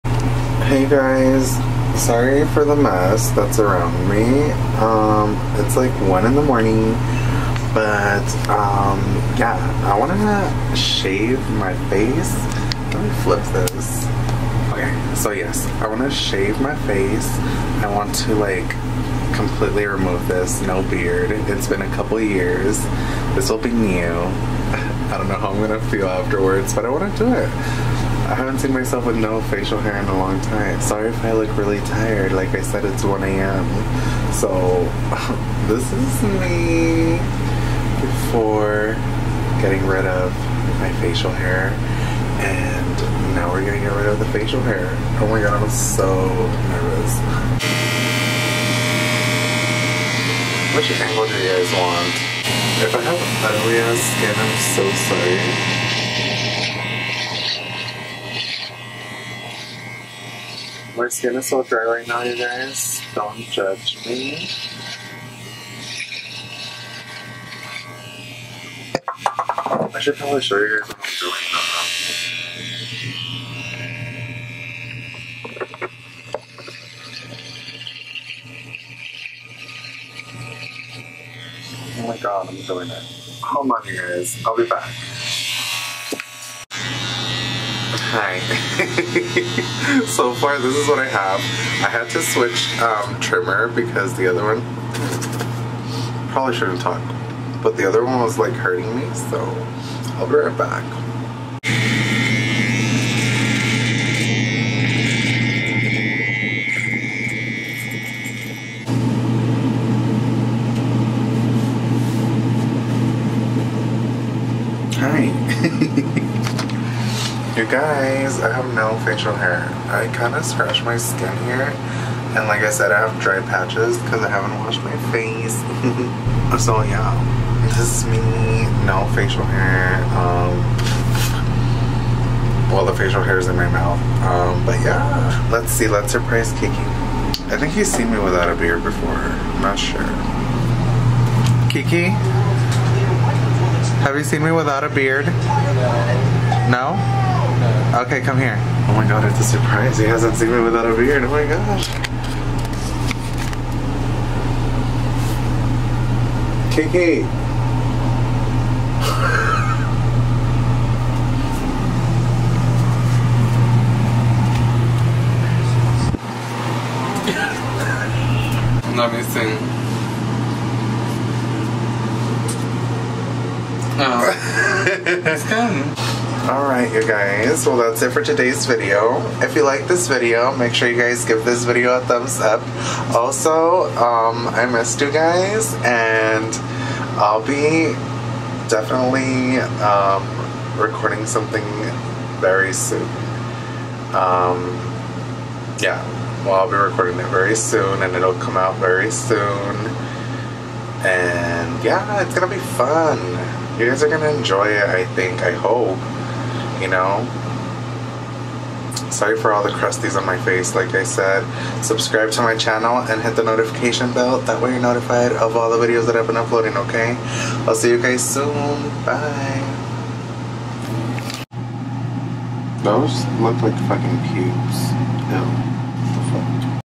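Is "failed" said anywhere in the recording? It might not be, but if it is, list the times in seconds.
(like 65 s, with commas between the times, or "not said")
not said.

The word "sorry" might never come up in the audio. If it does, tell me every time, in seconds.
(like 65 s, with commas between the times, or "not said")
2 s, 30 s, 55 s, 209 s.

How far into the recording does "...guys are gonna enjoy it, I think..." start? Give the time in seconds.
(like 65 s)
203 s.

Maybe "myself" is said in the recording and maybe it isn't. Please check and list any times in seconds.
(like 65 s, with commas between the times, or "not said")
28 s.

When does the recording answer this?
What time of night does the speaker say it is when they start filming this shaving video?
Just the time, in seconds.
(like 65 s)
6 s.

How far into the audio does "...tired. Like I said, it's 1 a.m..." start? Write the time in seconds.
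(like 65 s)
31 s.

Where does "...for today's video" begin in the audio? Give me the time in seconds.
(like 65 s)
178 s.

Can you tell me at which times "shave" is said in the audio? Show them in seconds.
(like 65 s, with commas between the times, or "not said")
10 s, 16 s.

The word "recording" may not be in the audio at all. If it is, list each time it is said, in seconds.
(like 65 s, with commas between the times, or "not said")
190 s, 196 s.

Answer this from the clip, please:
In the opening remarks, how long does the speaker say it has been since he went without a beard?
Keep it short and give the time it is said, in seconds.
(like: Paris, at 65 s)
A couple years, at 21 s.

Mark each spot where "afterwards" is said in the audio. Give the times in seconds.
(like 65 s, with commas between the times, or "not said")
26 s.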